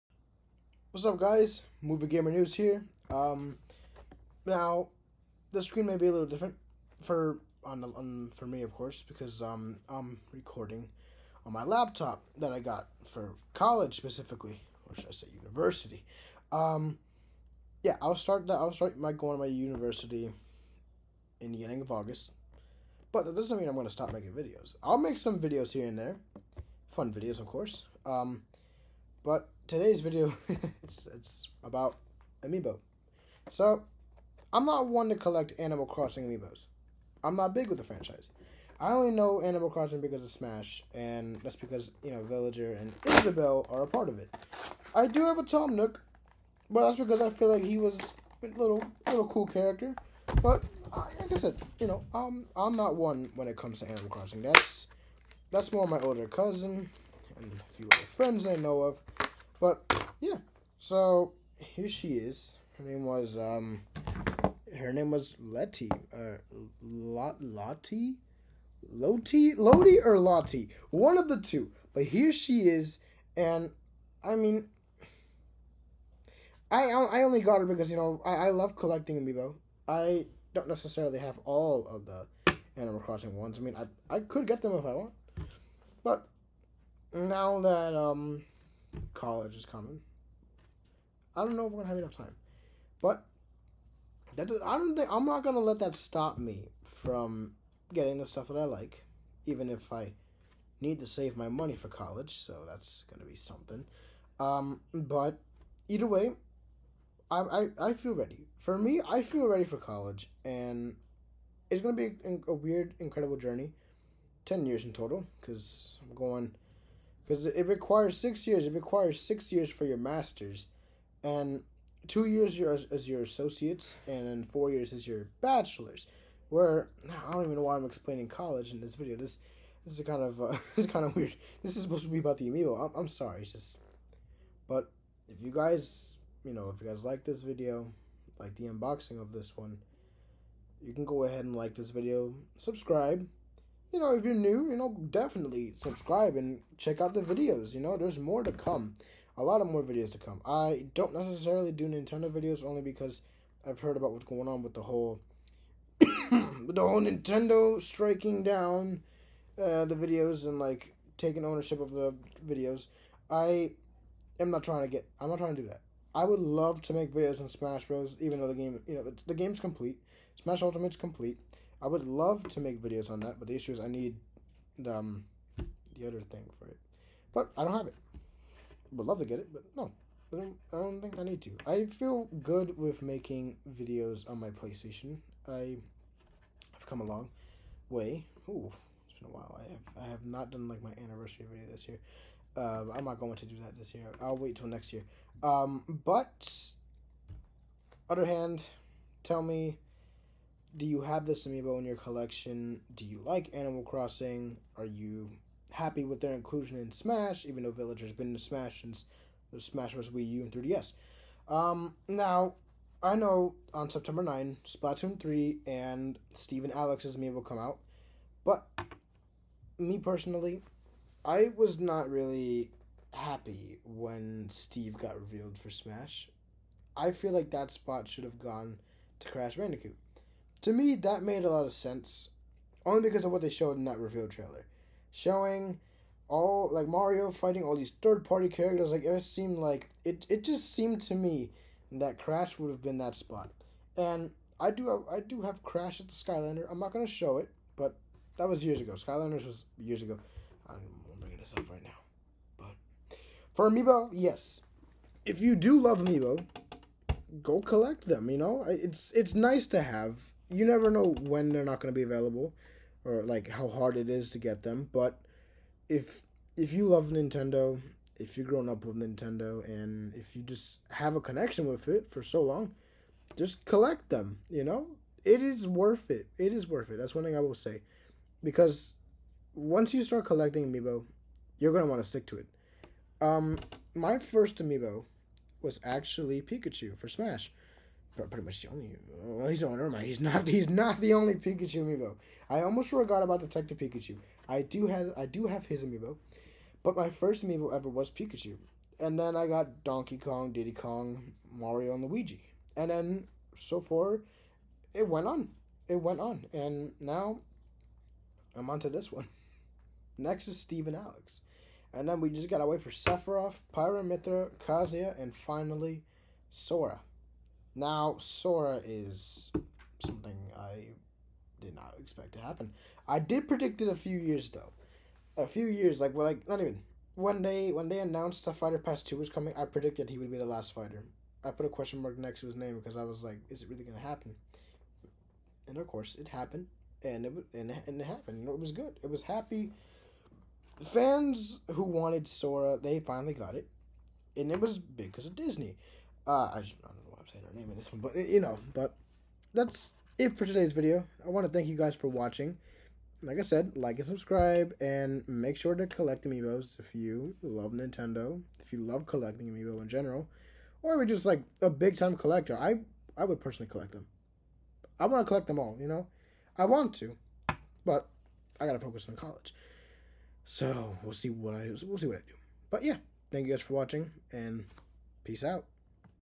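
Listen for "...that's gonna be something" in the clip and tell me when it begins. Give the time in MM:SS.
01:42.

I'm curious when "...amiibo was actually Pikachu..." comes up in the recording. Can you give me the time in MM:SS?
04:44.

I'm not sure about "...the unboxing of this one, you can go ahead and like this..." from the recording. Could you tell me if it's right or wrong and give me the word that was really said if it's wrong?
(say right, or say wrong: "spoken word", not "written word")
right.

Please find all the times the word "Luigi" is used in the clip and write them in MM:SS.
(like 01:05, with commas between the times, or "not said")
05:02.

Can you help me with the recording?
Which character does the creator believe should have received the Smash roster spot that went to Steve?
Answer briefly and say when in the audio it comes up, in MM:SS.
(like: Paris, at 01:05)
Crash Bandicoot, at 03:49.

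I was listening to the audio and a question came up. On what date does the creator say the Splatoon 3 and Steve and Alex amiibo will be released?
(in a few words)
September 9.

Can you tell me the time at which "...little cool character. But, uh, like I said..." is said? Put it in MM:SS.
00:49.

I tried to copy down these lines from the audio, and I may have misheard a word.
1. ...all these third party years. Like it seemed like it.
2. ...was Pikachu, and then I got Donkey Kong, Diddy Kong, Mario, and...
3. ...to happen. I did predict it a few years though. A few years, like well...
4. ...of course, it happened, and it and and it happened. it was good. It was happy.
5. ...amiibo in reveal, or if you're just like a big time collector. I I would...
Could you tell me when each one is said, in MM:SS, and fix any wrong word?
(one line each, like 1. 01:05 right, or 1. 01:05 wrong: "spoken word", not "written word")
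1. 03:57 wrong: "characters", not "years"
2. 04:57 right
3. 05:22 right
4. 05:35 right
5. 05:59 wrong: "general", not "reveal".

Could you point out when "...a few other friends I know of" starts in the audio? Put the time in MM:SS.
00:57.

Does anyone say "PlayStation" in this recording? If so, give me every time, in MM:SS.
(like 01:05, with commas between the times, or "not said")
03:04.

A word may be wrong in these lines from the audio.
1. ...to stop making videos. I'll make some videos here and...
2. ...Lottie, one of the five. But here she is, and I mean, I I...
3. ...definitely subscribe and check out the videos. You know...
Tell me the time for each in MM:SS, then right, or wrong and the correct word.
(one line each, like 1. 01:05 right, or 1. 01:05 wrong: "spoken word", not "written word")
1. 00:23 right
2. 01:10 wrong: "two", not "five"
3. 02:25 right.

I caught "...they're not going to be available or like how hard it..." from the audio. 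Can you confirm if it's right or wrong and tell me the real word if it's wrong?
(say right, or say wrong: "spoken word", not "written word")
right.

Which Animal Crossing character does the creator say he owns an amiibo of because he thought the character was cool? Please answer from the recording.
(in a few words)
Tom Nook.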